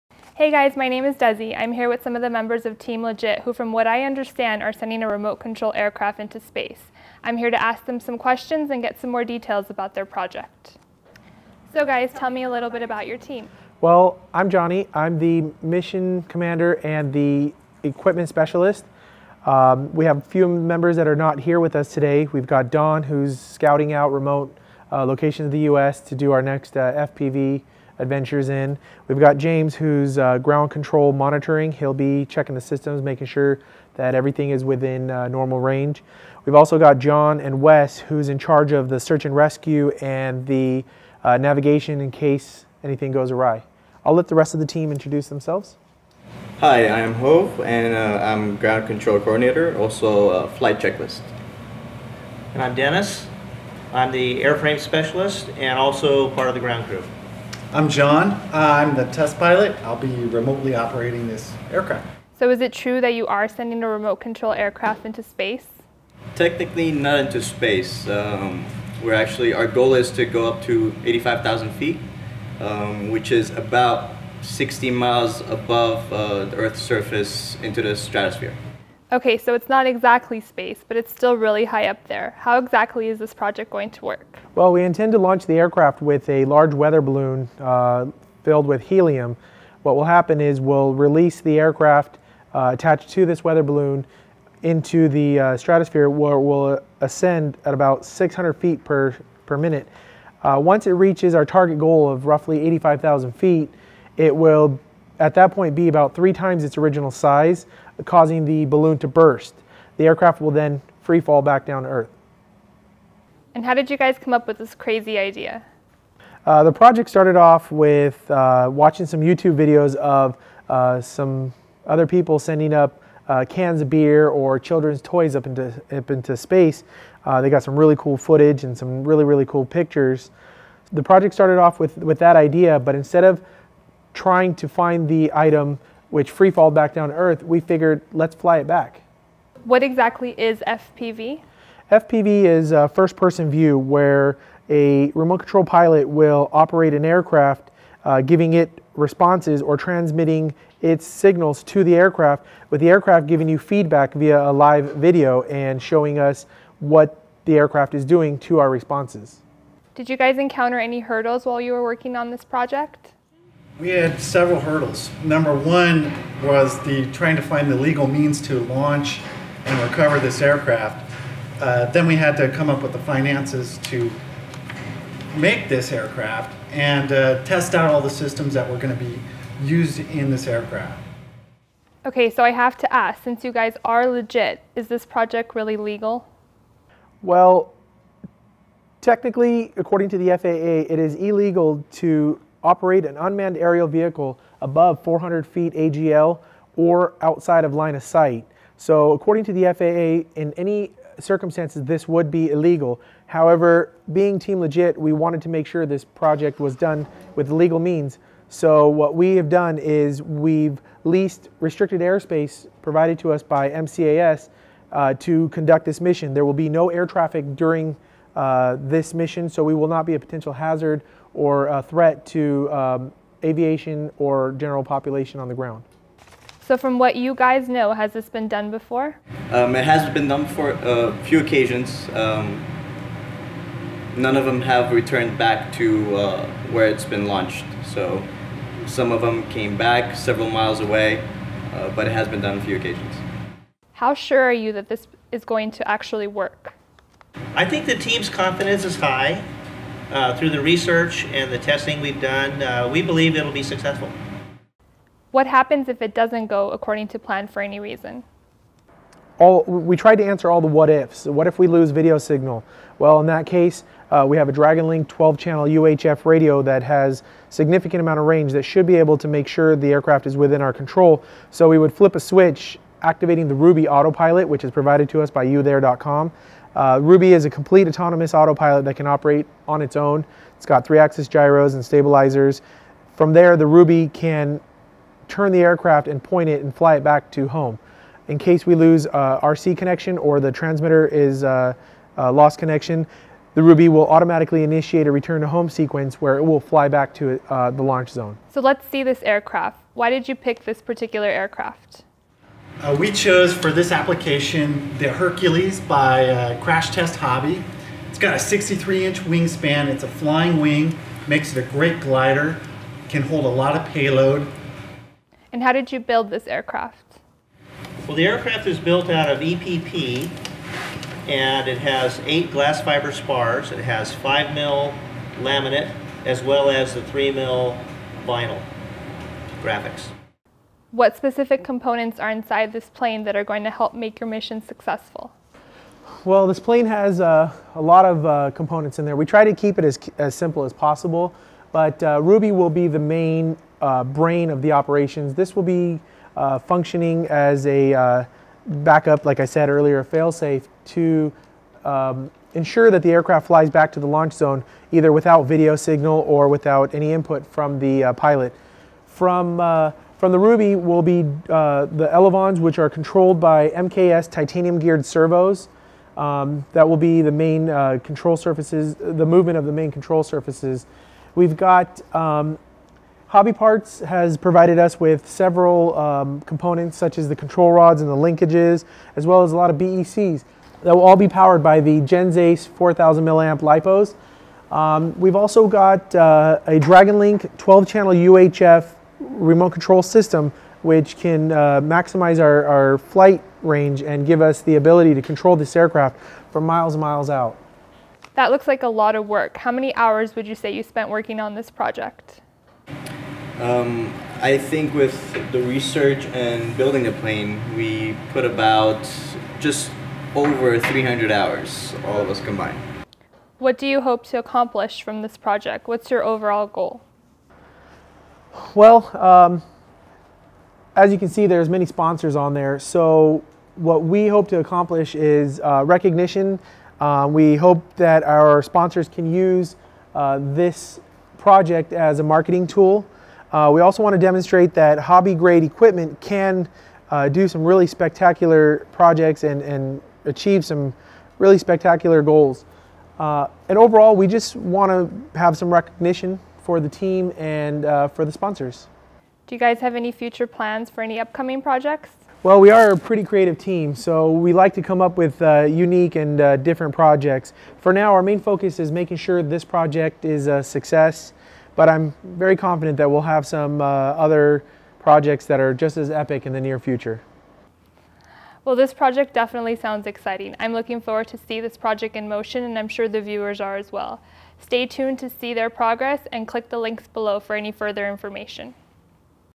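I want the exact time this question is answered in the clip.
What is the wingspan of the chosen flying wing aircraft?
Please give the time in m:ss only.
5:08.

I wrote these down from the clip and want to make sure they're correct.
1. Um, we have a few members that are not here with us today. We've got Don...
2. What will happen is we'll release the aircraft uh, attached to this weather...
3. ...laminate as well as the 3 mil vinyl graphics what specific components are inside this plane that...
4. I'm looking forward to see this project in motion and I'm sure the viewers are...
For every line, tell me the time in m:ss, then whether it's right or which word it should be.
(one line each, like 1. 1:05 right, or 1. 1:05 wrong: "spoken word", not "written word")
1. 0:19 right
2. 1:29 right
3. 5:25 right
4. 7:50 right.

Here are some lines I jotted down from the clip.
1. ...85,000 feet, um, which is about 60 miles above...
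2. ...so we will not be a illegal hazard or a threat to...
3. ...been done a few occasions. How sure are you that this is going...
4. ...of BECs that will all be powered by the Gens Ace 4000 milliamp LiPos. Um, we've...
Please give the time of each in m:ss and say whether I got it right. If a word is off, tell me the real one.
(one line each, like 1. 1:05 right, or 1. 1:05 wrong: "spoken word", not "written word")
1. 1:11 right
2. 3:39 wrong: "potential", not "illegal"
3. 4:02 right
4. 6:19 right.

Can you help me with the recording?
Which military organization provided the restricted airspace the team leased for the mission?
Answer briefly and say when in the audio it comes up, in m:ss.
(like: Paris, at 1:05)
MCAS, at 3:33.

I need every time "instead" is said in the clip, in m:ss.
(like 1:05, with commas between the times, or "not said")
2:12.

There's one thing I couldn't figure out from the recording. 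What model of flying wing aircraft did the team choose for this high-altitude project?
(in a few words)
Hercules.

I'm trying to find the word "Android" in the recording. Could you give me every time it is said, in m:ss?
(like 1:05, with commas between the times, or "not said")
not said.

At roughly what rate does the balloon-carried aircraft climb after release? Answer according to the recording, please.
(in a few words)
600 feet per minute.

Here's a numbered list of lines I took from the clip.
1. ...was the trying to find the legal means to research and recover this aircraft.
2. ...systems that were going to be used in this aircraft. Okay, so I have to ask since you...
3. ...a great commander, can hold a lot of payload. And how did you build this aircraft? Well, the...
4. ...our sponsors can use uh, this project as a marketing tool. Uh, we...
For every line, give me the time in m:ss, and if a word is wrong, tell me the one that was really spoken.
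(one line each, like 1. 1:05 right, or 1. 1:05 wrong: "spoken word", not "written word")
1. 2:46 wrong: "launch", not "research"
2. 2:58 right
3. 5:11 wrong: "glider", not "commander"
4. 7:08 right.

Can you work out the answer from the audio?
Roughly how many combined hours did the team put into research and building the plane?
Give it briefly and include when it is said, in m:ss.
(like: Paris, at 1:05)
300 hours, at 6:50.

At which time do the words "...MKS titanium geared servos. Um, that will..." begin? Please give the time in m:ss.
6:03.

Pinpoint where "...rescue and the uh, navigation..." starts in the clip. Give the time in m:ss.
0:39.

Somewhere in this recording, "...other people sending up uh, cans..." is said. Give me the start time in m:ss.
2:01.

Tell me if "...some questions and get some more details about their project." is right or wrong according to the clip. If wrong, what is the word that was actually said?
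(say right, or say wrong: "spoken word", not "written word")
right.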